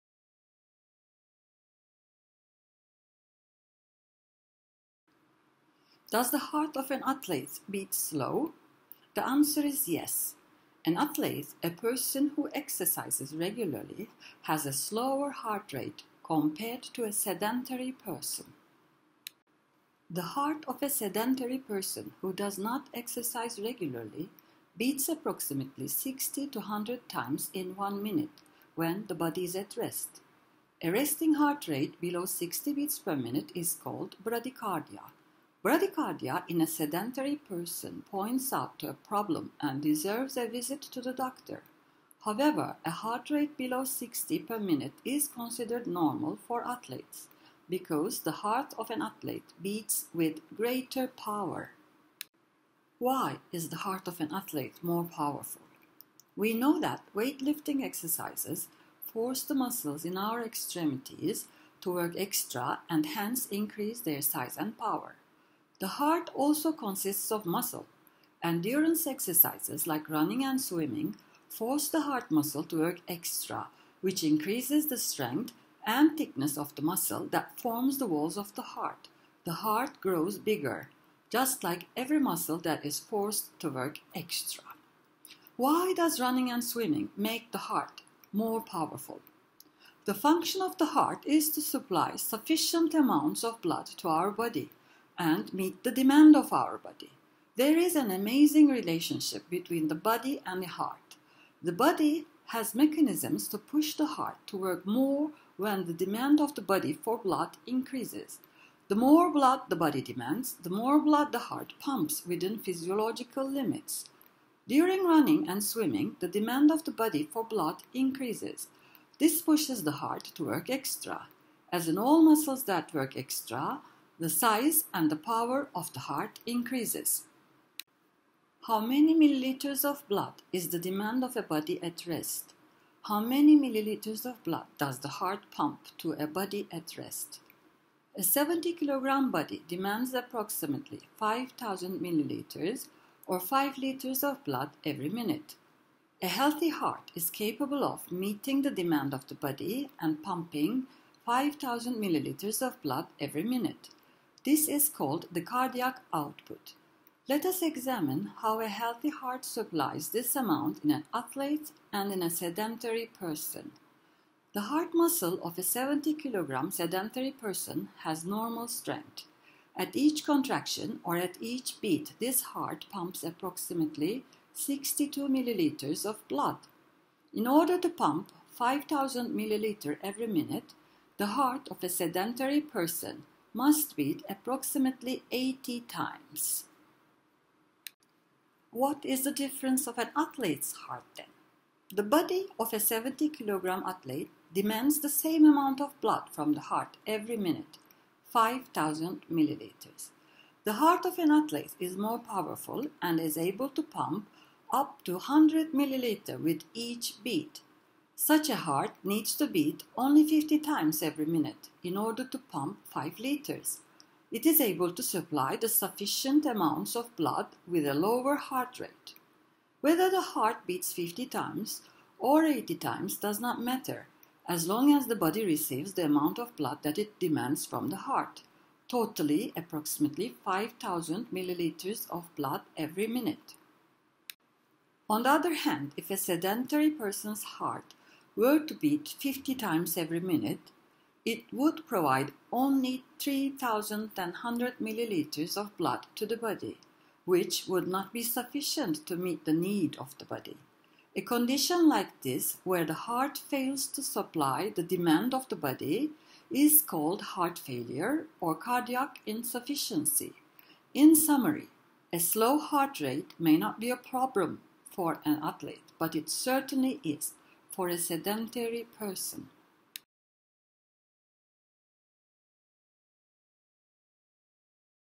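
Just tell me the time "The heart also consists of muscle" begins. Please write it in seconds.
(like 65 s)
65 s.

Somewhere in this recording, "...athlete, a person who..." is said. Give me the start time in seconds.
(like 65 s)
10 s.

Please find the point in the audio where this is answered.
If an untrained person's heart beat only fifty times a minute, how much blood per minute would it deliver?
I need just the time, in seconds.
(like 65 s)
243 s.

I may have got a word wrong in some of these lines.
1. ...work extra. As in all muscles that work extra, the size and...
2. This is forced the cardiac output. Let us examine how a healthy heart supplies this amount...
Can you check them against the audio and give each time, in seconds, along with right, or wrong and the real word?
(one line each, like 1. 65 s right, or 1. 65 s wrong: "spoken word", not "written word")
1. 120 s right
2. 154 s wrong: "called", not "forced".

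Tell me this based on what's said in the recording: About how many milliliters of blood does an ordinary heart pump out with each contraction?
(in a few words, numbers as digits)
62 milliliters.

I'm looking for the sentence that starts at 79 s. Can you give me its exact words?
The heart grows bigger, just like every muscle that is forced to work extra.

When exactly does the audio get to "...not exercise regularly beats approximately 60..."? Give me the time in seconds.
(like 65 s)
22 s.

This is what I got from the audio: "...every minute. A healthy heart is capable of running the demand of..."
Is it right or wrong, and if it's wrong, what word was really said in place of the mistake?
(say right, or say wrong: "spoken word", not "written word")
wrong: "meeting", not "running".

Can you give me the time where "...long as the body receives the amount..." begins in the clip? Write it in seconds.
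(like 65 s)
224 s.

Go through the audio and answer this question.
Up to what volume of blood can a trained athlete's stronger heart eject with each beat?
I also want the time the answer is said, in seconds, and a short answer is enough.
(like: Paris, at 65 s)
100 milliliters, at 205 s.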